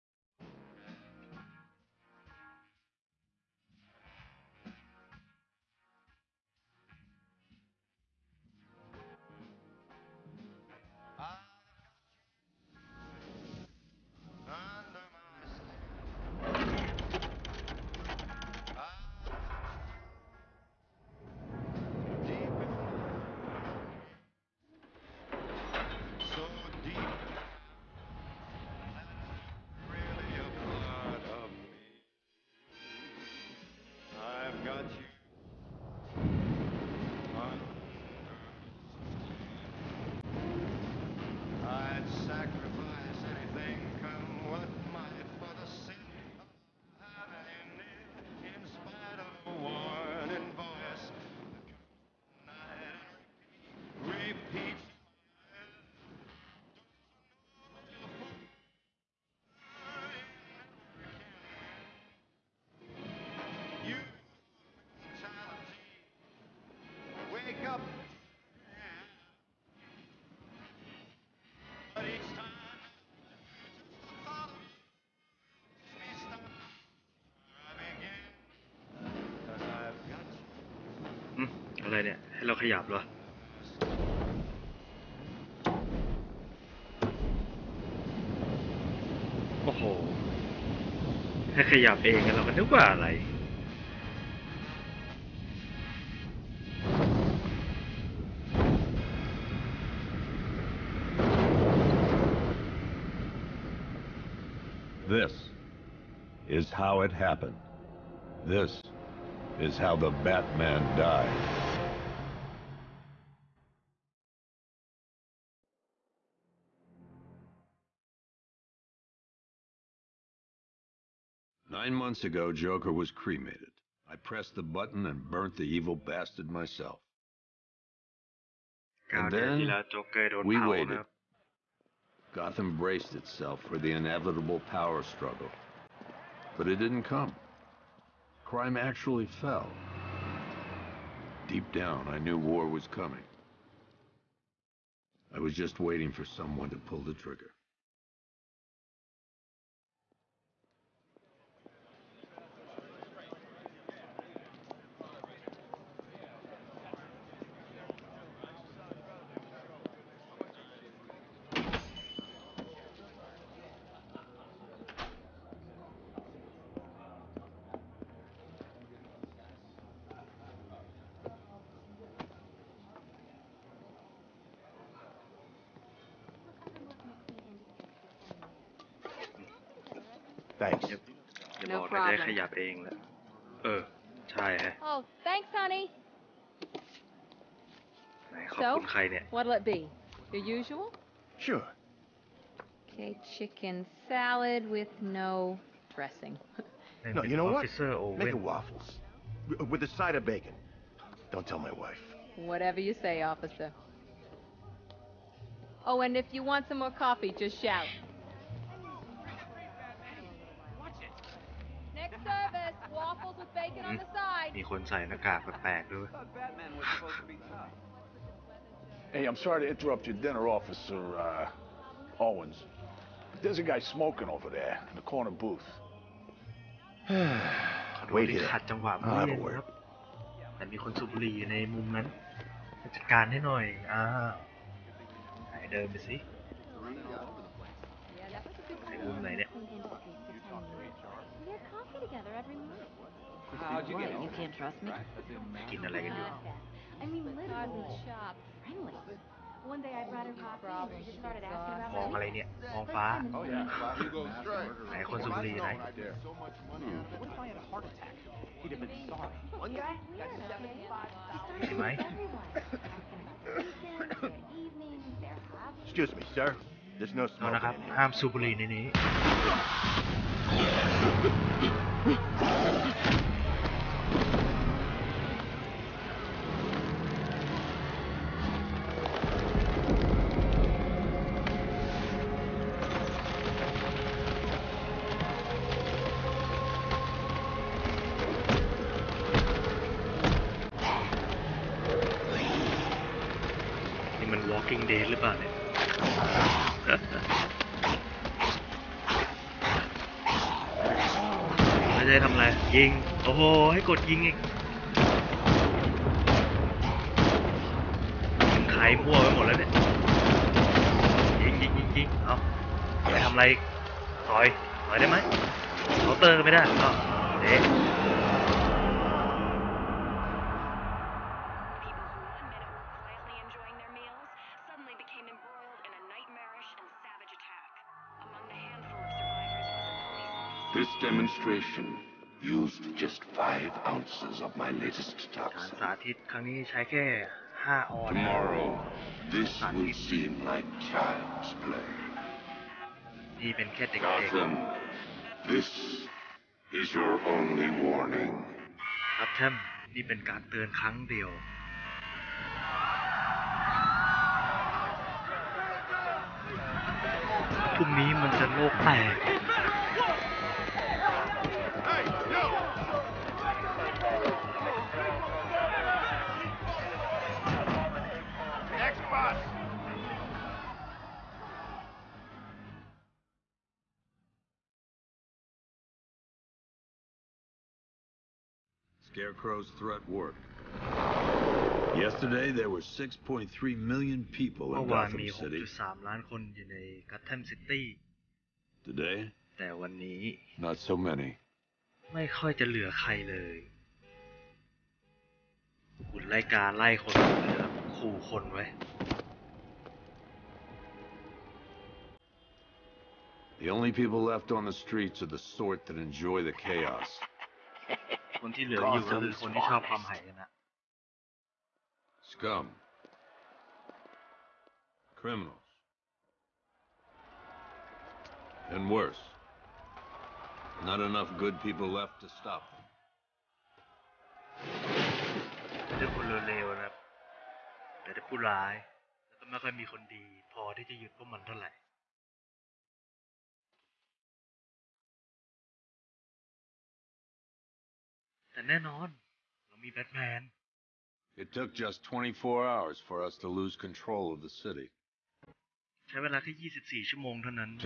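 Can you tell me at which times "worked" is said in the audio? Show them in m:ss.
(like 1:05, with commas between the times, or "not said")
6:20.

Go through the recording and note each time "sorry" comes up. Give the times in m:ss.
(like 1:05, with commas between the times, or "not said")
3:39, 4:19.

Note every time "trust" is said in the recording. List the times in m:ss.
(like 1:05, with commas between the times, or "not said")
4:04.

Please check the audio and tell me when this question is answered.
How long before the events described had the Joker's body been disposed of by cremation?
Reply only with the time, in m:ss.
2:01.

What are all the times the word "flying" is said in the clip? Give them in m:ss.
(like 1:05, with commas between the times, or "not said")
not said.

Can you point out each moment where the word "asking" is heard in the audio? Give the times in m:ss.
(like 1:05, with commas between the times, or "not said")
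4:11.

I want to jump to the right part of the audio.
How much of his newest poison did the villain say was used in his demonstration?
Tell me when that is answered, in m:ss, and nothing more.
5:33.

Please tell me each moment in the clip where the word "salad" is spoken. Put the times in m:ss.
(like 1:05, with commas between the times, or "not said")
3:14.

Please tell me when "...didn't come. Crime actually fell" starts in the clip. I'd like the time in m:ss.
2:16.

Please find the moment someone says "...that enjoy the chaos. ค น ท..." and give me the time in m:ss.
6:45.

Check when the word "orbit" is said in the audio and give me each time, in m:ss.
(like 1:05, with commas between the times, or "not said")
not said.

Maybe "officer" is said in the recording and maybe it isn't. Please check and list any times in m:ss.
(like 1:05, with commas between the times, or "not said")
3:23, 3:40.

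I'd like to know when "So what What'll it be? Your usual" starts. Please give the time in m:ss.
3:08.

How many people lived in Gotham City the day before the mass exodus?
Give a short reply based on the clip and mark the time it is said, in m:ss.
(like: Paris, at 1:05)
6.3 million, at 6:22.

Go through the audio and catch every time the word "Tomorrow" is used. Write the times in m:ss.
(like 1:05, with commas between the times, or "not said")
5:38.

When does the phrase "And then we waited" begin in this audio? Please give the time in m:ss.
2:09.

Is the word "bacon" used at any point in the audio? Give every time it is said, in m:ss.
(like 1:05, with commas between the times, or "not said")
3:20, 3:33.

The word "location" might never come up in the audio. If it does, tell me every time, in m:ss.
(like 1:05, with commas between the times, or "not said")
not said.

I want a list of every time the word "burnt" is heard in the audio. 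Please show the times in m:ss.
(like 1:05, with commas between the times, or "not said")
2:05.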